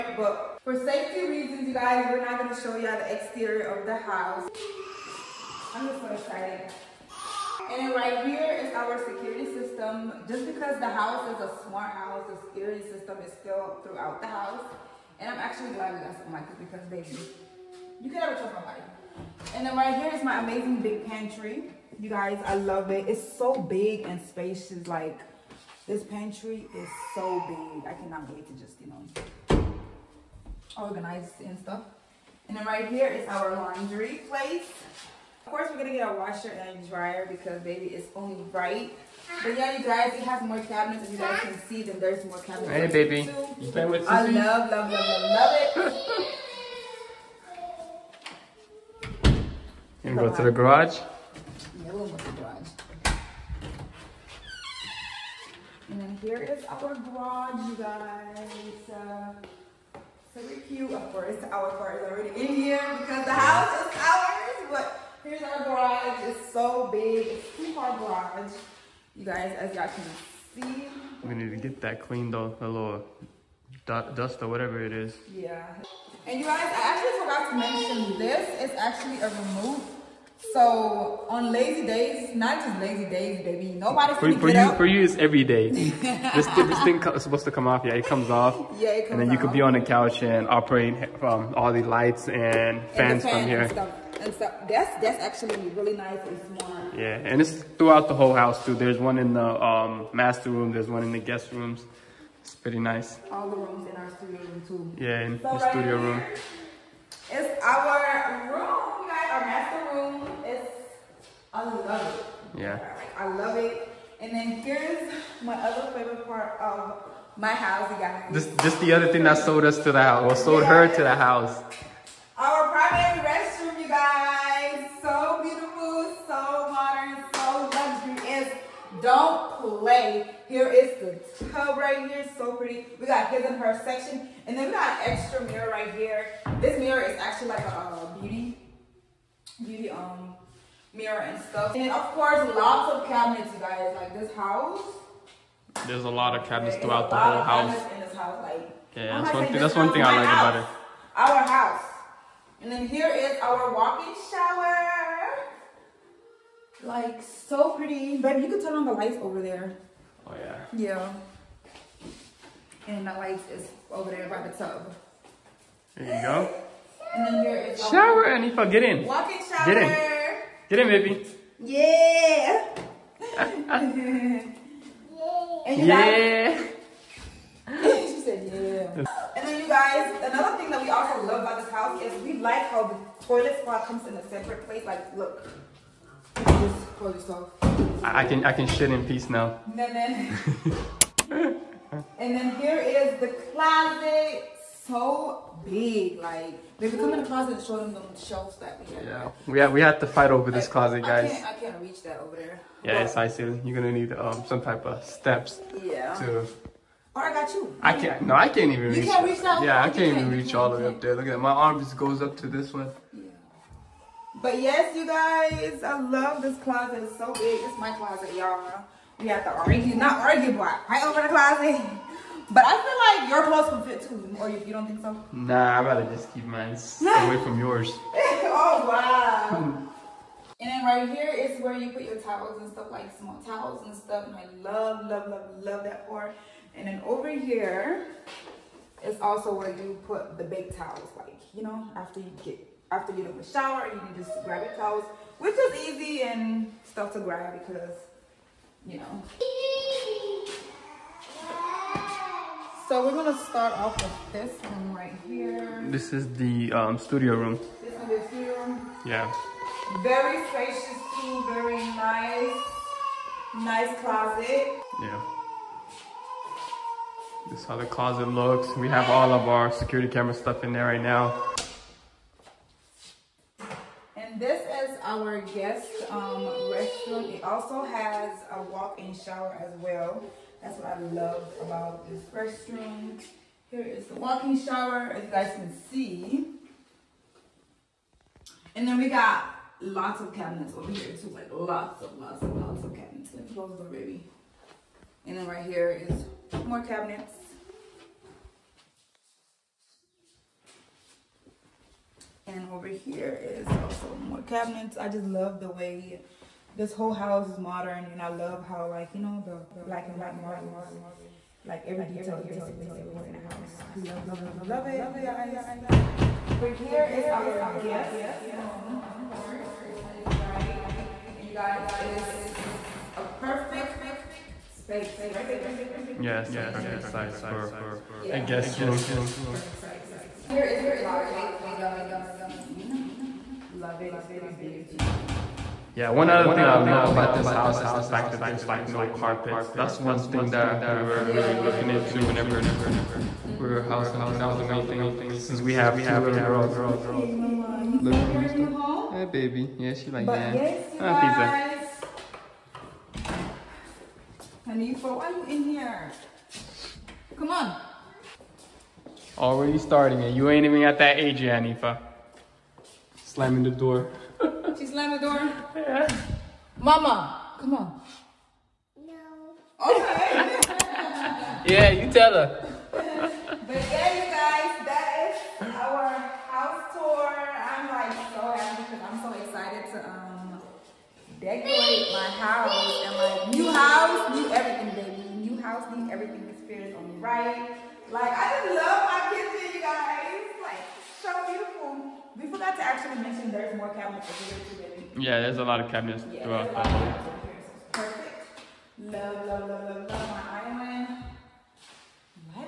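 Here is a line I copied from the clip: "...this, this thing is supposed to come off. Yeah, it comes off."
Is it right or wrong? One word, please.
right.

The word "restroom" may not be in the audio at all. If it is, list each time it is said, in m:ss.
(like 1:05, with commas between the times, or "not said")
2:03, 4:36.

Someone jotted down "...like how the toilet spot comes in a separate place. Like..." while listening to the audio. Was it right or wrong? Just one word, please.
right.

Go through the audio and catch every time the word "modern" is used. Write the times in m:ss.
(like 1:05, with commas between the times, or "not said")
2:06, 5:07.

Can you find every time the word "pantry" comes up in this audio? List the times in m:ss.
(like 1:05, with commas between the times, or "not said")
0:21, 0:26.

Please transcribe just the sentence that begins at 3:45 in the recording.
Nah, I'd rather just keep mine away from yours.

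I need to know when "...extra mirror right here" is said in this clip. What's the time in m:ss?
2:15.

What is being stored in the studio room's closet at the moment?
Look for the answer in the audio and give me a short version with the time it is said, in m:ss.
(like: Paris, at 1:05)
security camera stuff, at 4:29.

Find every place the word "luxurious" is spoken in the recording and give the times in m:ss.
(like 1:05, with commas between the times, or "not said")
2:07.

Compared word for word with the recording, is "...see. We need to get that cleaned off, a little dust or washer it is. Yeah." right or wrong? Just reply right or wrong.
wrong.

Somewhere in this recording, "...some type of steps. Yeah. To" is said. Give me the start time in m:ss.
3:24.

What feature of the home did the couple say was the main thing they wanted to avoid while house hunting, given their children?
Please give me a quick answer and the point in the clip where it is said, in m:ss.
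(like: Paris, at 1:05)
carpets, at 5:38.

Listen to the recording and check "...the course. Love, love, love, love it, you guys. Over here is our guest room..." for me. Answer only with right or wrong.
wrong.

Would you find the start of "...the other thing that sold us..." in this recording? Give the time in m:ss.
1:58.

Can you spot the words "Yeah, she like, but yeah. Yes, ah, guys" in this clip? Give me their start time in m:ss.
5:49.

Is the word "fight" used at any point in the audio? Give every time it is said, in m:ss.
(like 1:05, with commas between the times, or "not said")
3:20, 3:40.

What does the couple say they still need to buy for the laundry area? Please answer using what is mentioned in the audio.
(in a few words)
a washer and a dryer.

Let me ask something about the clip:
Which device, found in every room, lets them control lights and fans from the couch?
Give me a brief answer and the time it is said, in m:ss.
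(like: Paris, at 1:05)
a remote, at 1:19.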